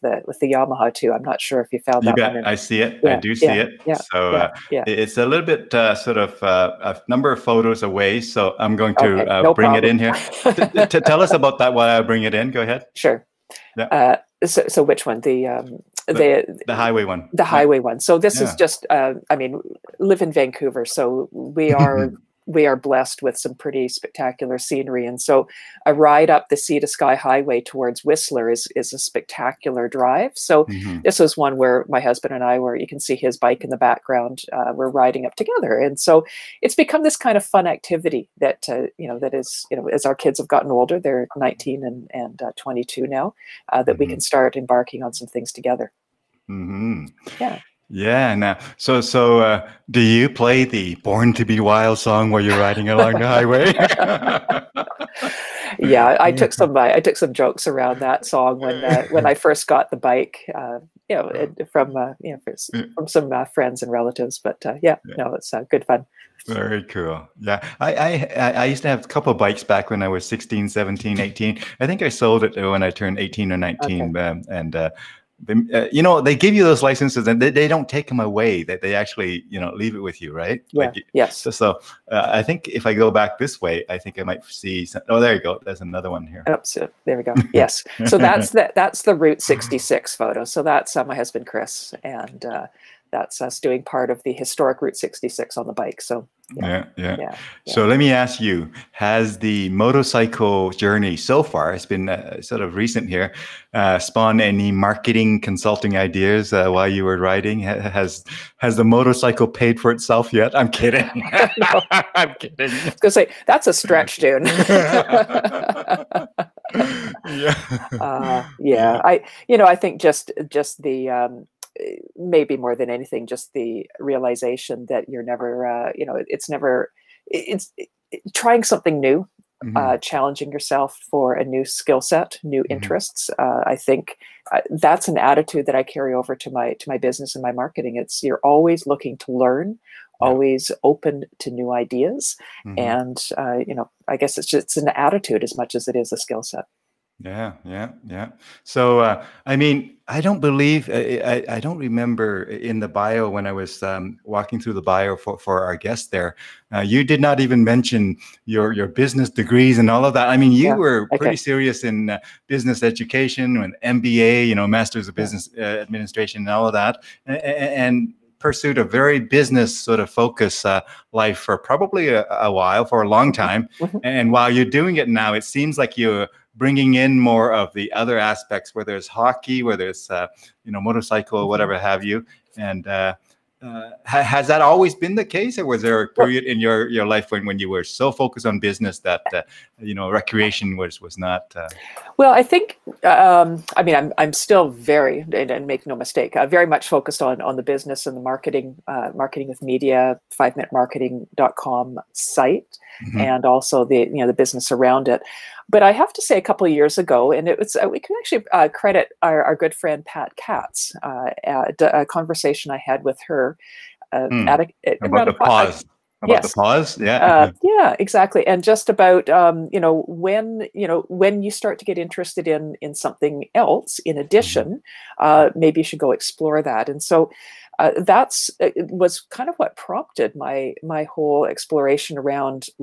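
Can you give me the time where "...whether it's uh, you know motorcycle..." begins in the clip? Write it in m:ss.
2:59.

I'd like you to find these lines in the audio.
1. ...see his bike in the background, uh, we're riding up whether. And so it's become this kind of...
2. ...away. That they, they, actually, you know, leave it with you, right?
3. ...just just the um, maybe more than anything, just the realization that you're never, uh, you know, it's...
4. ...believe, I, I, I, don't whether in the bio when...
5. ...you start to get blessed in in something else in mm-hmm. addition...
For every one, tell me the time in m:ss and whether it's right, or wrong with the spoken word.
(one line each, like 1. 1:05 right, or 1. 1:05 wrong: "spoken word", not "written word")
1. 0:33 wrong: "together", not "whether"
2. 1:18 right
3. 2:00 right
4. 2:30 wrong: "remember", not "whether"
5. 3:41 wrong: "interested", not "blessed".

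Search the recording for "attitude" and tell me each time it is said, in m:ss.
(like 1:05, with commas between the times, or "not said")
2:15, 2:24.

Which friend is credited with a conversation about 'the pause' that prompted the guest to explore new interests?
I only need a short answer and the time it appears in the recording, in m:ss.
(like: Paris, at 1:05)
Pat Katz, at 3:30.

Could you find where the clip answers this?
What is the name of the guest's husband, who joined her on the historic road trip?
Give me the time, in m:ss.
1:31.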